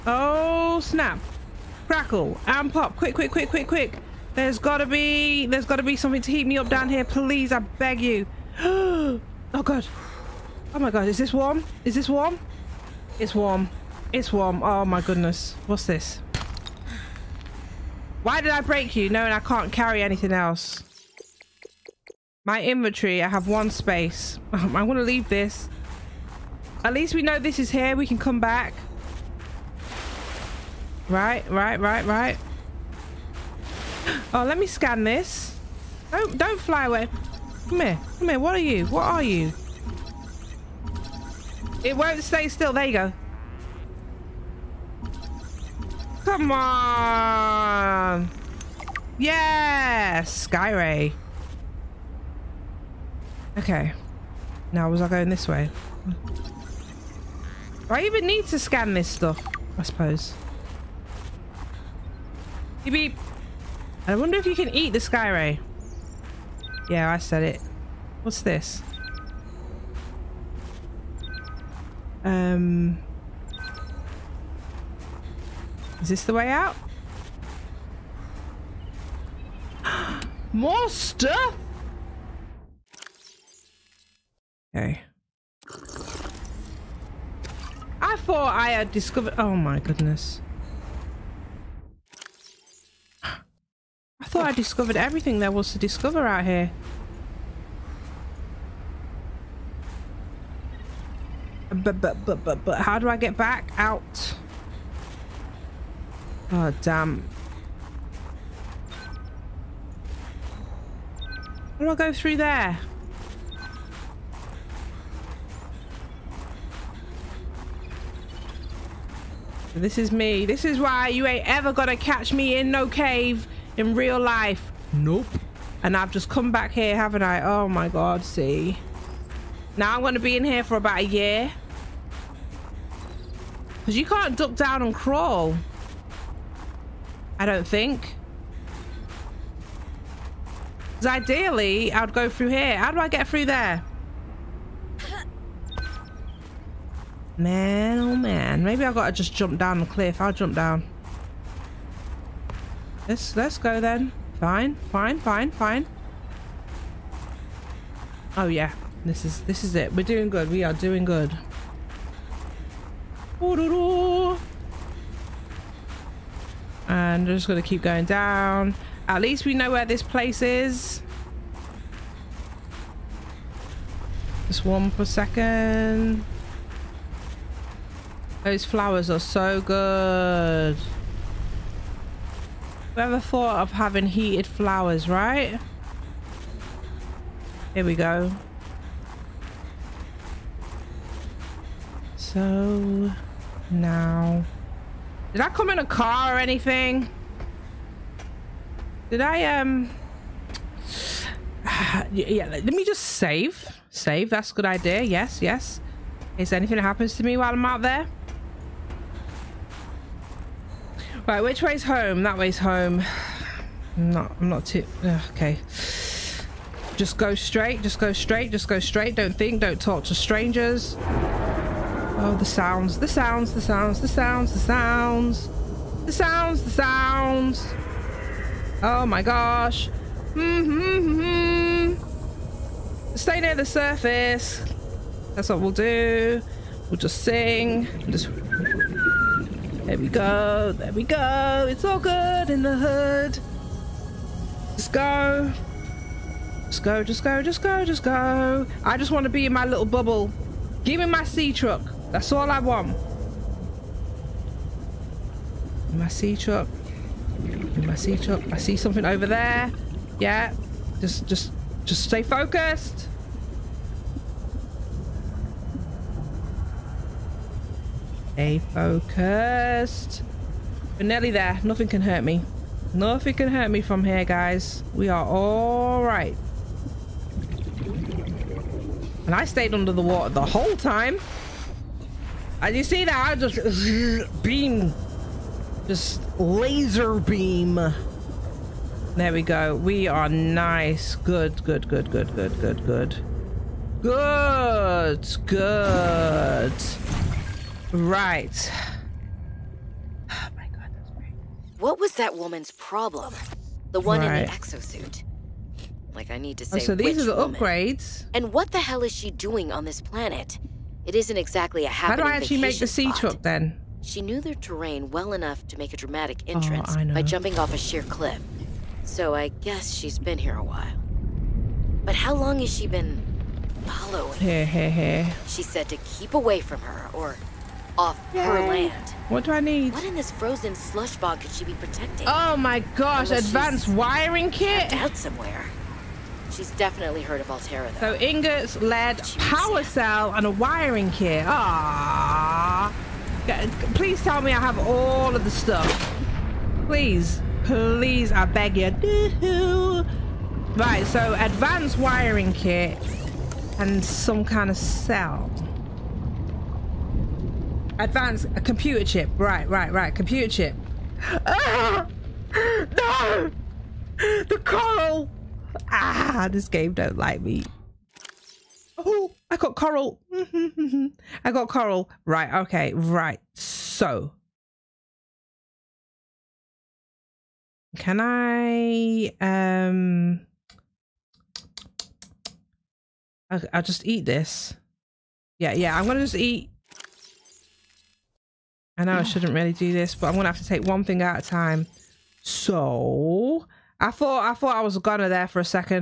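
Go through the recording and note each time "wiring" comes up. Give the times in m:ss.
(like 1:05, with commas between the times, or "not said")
5:33, 5:40, 5:51.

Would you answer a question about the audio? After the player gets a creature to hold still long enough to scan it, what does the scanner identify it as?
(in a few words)
Skyray.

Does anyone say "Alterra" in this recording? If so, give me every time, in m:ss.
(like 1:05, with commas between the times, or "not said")
5:37.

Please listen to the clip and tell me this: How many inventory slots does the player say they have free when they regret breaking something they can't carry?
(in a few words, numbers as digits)
1.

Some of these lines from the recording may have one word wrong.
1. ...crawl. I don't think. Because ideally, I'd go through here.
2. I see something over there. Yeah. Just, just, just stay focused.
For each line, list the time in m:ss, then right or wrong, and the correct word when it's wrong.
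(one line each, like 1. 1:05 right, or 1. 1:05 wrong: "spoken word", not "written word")
1. 2:14 right
2. 4:18 right.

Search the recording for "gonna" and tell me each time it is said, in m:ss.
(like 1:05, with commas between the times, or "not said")
2:01, 2:47, 6:26, 6:30, 6:34.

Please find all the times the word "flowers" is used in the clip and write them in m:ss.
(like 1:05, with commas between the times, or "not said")
2:58, 3:04.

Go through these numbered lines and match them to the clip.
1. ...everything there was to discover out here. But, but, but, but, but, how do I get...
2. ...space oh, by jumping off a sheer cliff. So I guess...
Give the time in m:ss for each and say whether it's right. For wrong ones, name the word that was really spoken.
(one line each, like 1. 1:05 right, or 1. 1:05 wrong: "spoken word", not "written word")
1. 1:34 right
2. 5:16 wrong: "entrance", not "space".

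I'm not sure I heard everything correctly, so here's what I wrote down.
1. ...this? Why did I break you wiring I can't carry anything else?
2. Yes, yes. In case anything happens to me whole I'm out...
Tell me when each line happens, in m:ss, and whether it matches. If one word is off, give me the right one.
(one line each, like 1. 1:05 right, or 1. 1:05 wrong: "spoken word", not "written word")
1. 0:15 wrong: "knowing", not "wiring"
2. 3:25 wrong: "while", not "whole".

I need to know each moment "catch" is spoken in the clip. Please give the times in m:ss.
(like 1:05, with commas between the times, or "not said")
2:01.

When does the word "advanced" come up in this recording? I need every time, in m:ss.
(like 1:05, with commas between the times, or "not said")
5:33, 5:51, 5:57.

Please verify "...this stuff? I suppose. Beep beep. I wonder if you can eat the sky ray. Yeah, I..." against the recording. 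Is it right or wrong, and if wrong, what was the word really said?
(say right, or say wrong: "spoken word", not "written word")
right.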